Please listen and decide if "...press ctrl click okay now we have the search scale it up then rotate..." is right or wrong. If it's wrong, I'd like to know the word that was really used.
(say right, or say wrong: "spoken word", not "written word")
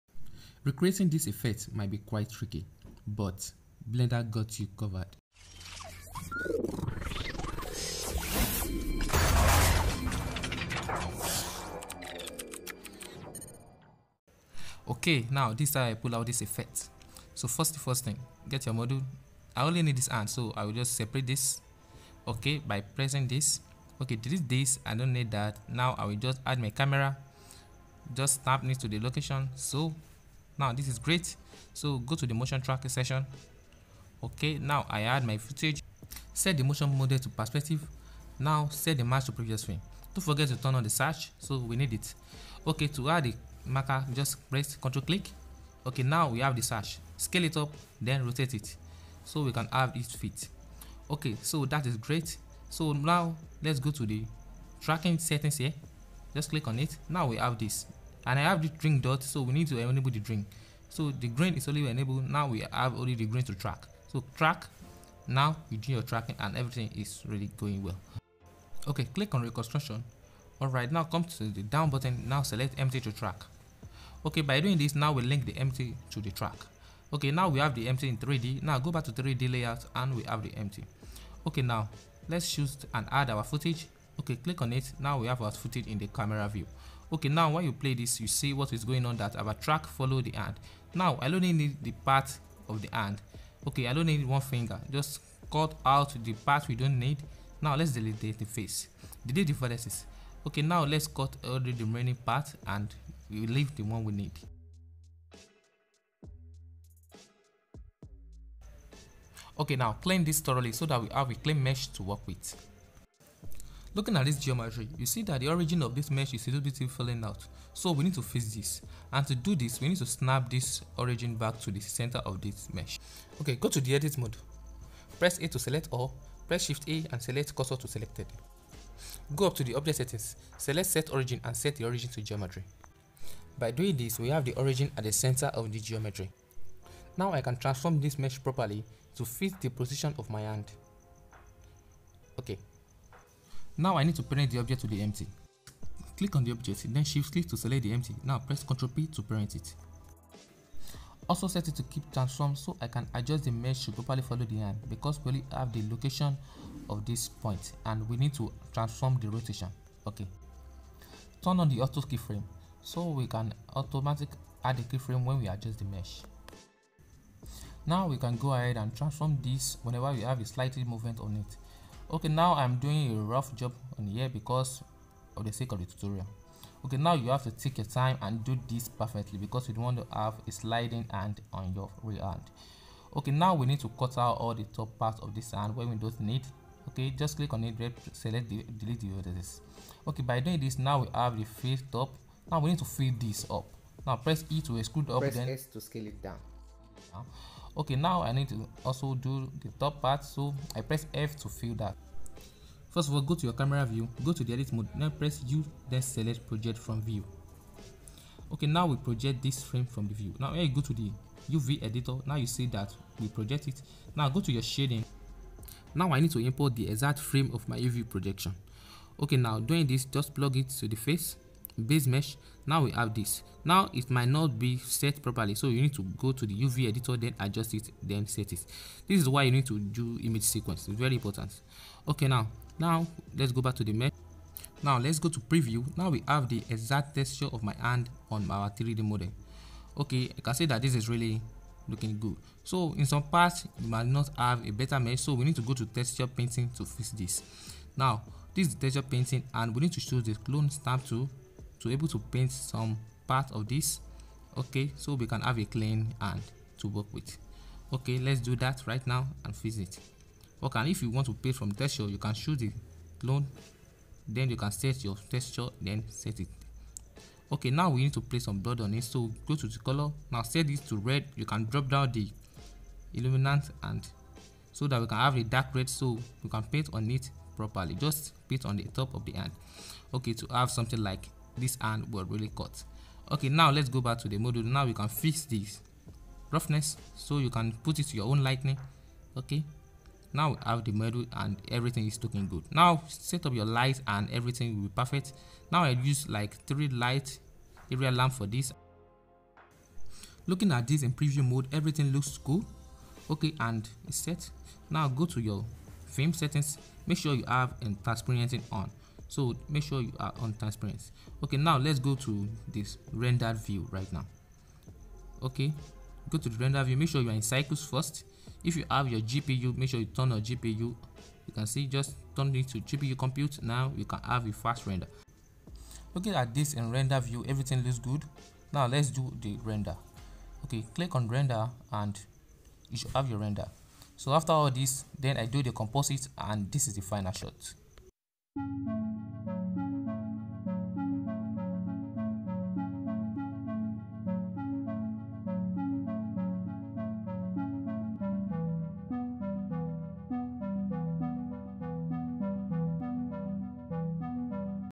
right.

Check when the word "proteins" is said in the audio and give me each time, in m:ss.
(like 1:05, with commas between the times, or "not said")
not said.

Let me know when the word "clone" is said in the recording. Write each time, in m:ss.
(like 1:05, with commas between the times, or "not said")
4:10, 4:23.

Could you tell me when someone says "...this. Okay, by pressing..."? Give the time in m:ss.
0:21.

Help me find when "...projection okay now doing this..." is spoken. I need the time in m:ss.
3:38.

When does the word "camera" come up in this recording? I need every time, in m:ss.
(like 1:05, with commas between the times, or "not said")
0:26, 1:26, 3:23.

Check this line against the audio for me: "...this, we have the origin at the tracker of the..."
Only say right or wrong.
wrong.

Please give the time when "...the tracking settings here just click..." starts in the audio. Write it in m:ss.
0:54.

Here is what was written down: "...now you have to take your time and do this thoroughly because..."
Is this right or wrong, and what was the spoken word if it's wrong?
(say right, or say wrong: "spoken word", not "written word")
wrong: "perfectly", not "thoroughly".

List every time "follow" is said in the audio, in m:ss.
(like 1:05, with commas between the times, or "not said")
1:29, 2:34.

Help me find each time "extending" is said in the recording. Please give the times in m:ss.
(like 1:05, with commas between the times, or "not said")
not said.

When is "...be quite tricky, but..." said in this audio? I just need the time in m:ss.
0:01.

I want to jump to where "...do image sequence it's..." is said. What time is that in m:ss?
3:49.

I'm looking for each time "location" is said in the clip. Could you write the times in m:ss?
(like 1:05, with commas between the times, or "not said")
0:28, 2:35.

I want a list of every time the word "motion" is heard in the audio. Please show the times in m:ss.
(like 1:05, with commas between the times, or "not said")
0:32, 0:36.